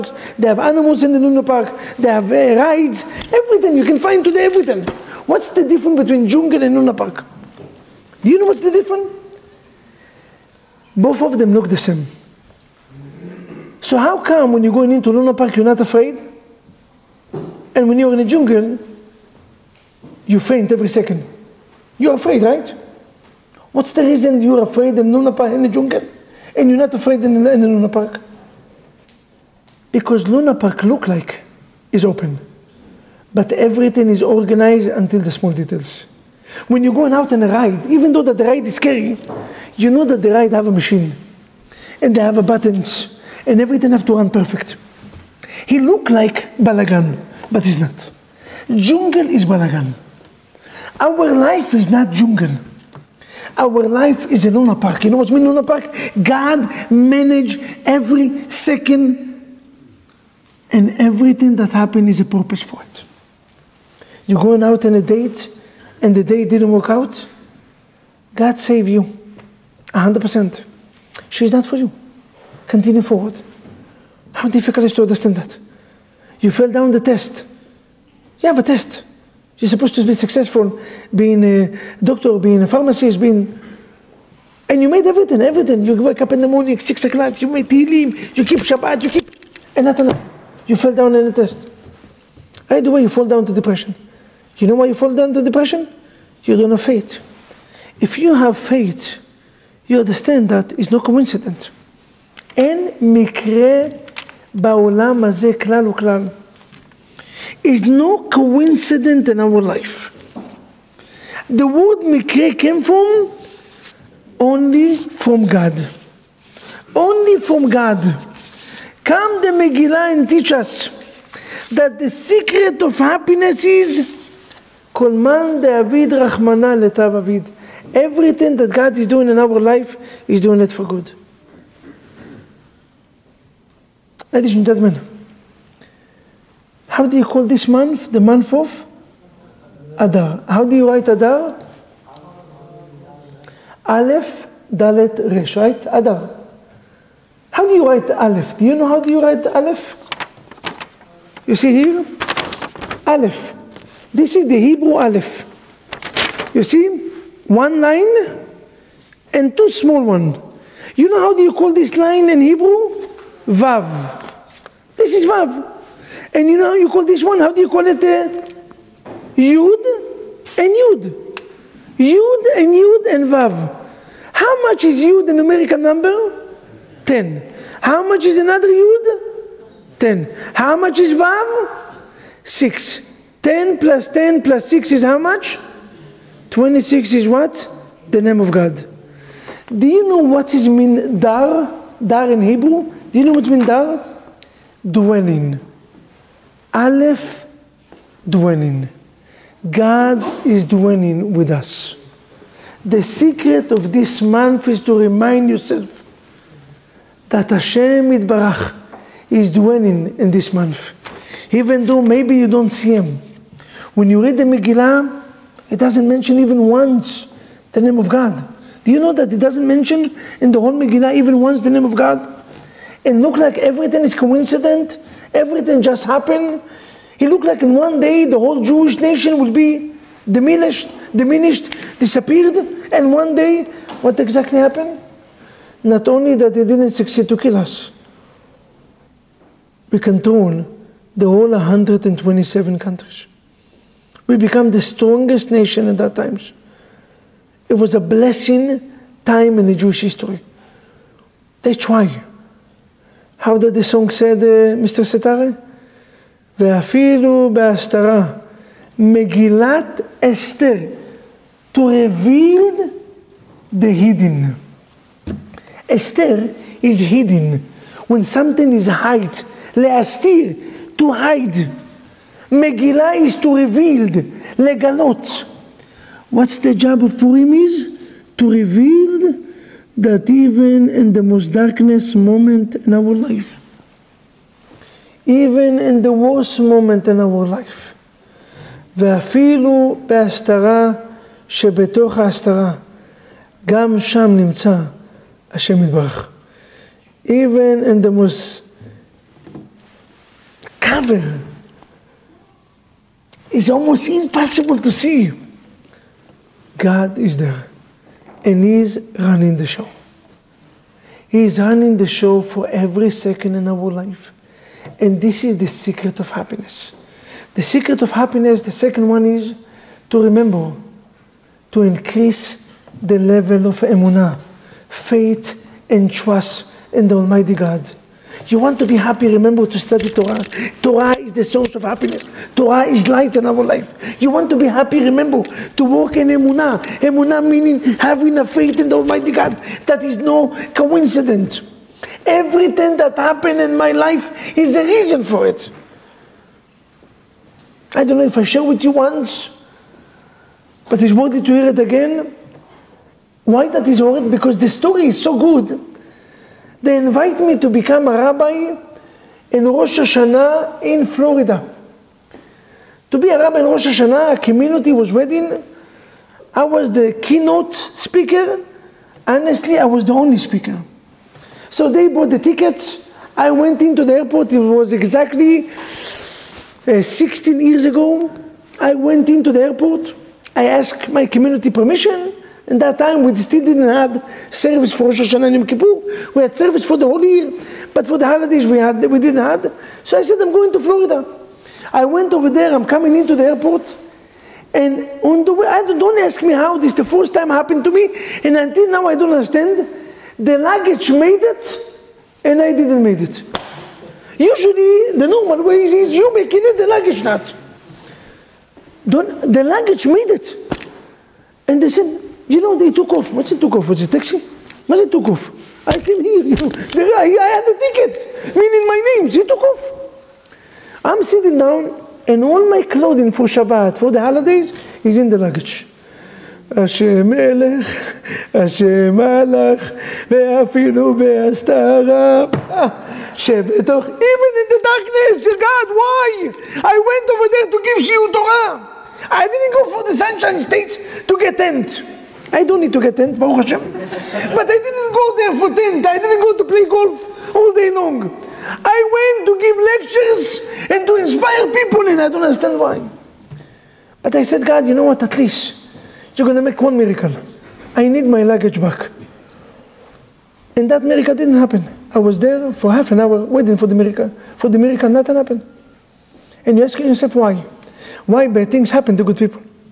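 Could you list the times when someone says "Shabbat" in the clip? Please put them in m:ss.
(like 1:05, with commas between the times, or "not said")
1:28, 7:03.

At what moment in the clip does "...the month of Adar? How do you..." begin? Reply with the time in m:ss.
2:18.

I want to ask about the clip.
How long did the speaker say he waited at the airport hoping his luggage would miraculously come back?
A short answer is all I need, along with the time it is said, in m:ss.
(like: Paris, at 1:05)
Half an hour, at 7:42.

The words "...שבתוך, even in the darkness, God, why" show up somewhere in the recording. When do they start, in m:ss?
7:13.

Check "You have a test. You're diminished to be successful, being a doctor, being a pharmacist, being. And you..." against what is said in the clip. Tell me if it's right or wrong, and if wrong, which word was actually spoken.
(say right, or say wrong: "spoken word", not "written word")
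wrong: "supposed", not "diminished".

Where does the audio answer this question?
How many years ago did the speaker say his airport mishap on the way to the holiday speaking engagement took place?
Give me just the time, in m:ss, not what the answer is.
6:17.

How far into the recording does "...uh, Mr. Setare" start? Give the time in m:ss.
4:14.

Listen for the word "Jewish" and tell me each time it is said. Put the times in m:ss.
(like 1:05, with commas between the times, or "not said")
3:48, 4:09.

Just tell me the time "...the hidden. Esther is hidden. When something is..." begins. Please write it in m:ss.
4:23.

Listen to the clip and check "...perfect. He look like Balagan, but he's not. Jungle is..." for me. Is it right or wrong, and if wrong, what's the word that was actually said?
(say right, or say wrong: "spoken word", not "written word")
right.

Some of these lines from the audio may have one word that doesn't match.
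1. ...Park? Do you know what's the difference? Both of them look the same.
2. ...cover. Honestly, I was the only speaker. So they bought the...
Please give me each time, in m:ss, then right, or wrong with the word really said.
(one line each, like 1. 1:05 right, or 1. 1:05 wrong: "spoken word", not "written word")
1. 0:06 right
2. 6:07 wrong: "speaker", not "cover".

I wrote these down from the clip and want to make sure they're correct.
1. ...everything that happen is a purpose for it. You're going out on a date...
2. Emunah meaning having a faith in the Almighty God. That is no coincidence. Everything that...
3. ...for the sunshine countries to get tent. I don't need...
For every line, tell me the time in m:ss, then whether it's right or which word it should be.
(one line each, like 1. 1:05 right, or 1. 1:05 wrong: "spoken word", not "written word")
1. 1:01 right
2. 5:37 right
3. 7:19 wrong: "states", not "countries".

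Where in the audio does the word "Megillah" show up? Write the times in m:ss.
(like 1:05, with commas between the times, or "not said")
1:59, 3:34, 3:40, 4:32.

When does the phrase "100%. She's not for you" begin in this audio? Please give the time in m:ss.
1:09.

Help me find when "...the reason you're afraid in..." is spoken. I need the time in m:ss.
0:23.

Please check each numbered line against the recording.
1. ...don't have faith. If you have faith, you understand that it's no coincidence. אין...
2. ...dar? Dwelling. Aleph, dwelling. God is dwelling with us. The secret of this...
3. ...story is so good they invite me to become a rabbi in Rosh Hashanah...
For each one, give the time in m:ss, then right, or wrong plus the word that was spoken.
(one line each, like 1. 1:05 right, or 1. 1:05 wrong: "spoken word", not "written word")
1. 1:36 right
2. 3:13 right
3. 5:54 right.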